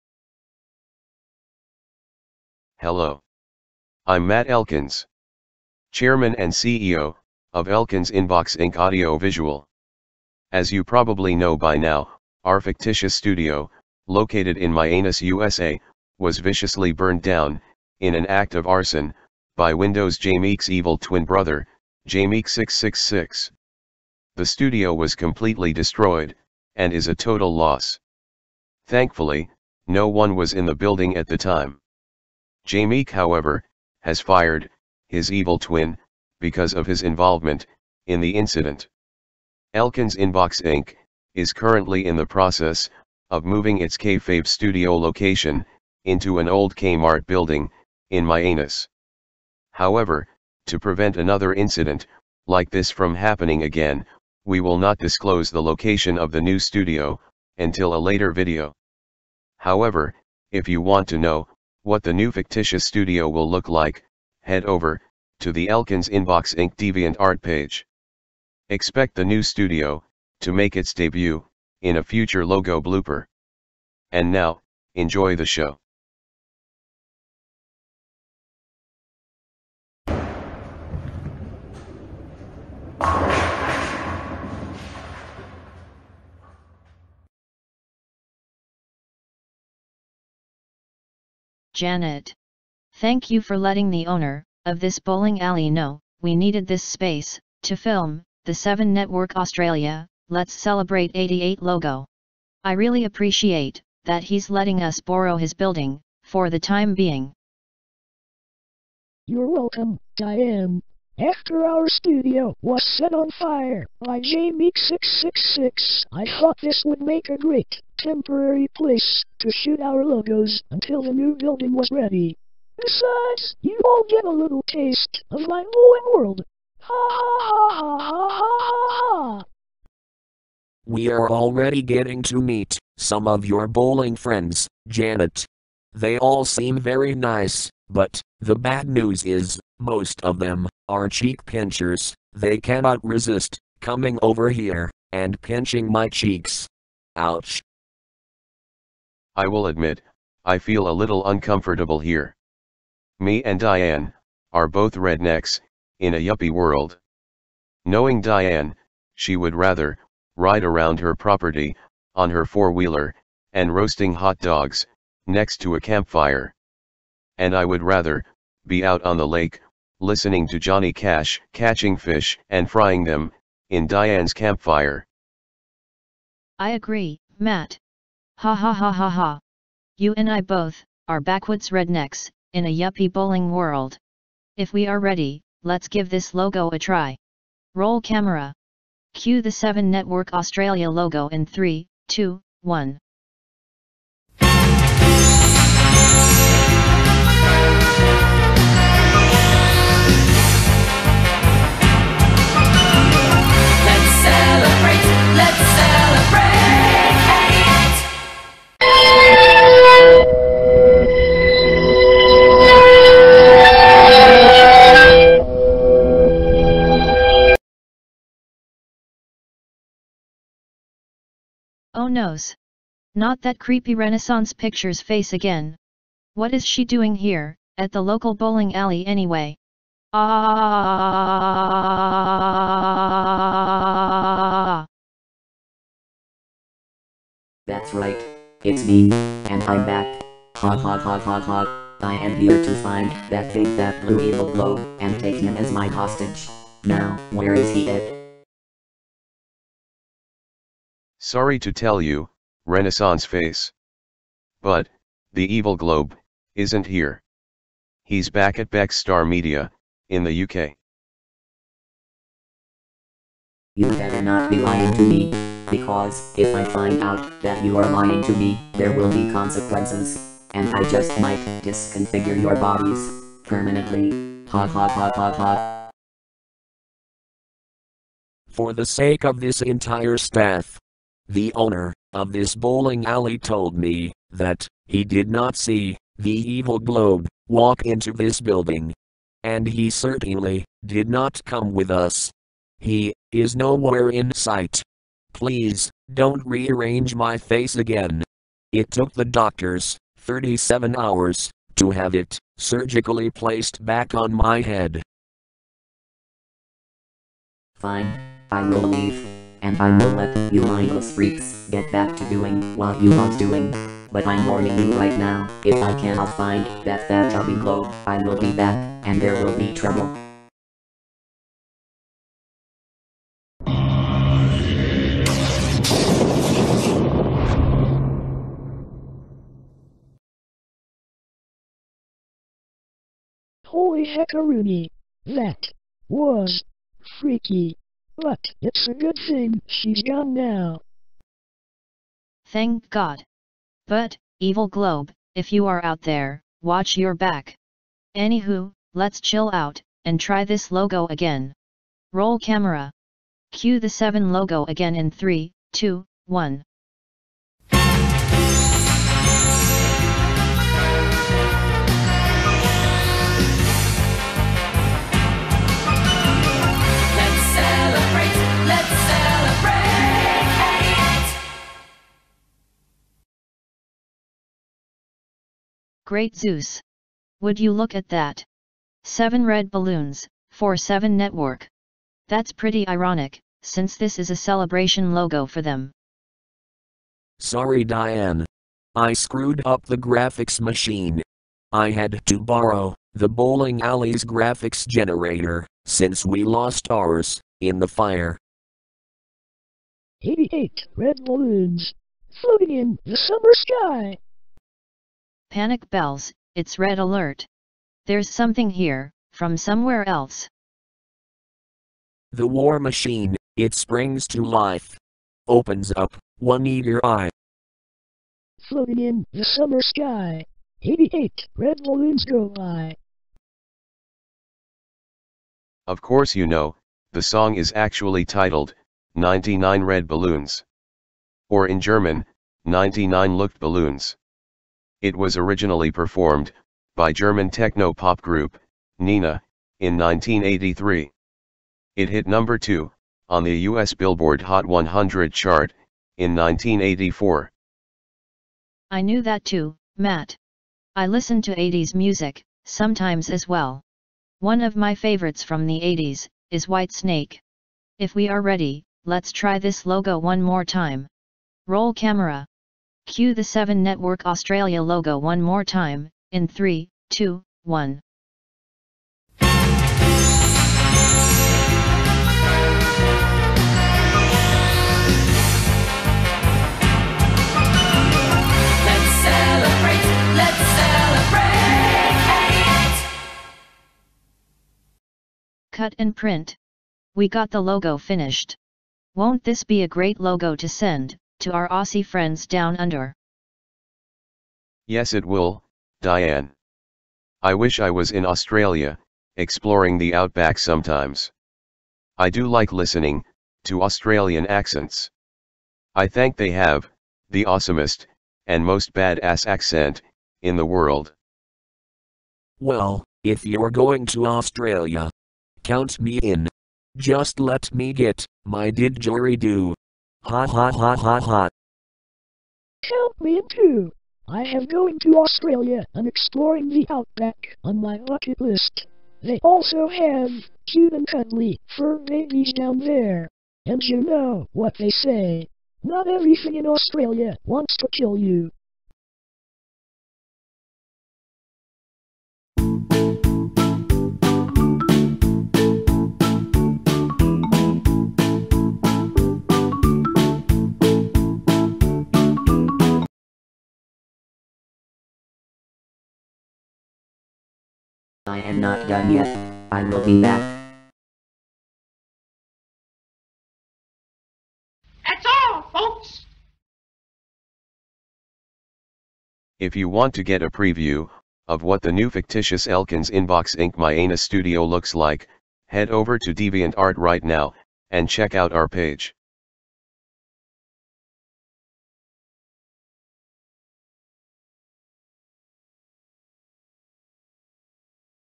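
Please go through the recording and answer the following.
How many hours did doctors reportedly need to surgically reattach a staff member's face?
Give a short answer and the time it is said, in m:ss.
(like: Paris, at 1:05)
37, at 5:00.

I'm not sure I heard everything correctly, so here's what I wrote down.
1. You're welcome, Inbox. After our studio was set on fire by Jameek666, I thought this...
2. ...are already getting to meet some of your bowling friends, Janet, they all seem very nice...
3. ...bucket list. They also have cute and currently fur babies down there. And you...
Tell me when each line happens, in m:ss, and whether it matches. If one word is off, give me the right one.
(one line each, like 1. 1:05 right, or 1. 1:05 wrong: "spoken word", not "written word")
1. 1:49 wrong: "Diane", not "Inbox"
2. 2:11 right
3. 8:47 wrong: "cuddly", not "currently".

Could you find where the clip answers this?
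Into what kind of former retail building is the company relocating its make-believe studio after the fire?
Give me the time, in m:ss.
0:46.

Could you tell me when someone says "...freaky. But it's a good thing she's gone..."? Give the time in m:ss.
5:37.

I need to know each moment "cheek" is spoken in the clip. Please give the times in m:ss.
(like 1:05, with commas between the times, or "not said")
2:21, 2:26.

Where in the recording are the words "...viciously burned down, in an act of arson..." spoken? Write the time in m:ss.
0:16.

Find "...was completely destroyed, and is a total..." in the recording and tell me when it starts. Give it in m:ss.
0:24.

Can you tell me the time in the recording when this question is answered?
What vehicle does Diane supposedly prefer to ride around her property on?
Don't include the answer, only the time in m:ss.
2:42.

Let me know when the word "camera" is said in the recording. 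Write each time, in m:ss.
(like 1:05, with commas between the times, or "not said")
3:08, 5:52, 7:41.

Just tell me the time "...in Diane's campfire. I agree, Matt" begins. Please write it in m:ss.
2:53.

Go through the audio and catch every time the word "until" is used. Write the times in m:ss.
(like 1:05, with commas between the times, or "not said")
0:57, 2:00.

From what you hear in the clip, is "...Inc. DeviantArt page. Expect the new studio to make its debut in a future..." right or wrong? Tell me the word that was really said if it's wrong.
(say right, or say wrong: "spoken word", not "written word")
right.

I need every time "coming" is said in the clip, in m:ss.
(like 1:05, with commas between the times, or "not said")
2:23.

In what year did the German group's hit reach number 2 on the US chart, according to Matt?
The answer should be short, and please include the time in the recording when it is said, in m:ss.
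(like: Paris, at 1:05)
1984, at 7:26.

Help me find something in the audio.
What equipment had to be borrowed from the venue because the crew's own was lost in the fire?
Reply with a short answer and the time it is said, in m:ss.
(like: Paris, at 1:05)
graphics generator, at 6:34.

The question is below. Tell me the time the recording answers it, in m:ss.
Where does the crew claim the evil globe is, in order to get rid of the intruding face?
4:18.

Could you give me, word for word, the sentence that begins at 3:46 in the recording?
What is she doing here, at the local bowling alley anyway?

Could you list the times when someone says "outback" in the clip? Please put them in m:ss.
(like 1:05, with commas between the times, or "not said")
8:20, 8:46.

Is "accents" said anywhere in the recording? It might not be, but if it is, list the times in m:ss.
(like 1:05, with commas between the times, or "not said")
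8:24, 8:29.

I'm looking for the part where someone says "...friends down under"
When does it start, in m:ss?
8:12.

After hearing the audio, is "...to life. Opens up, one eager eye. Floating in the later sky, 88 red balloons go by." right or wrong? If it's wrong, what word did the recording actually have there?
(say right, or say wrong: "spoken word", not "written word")
wrong: "summer", not "later".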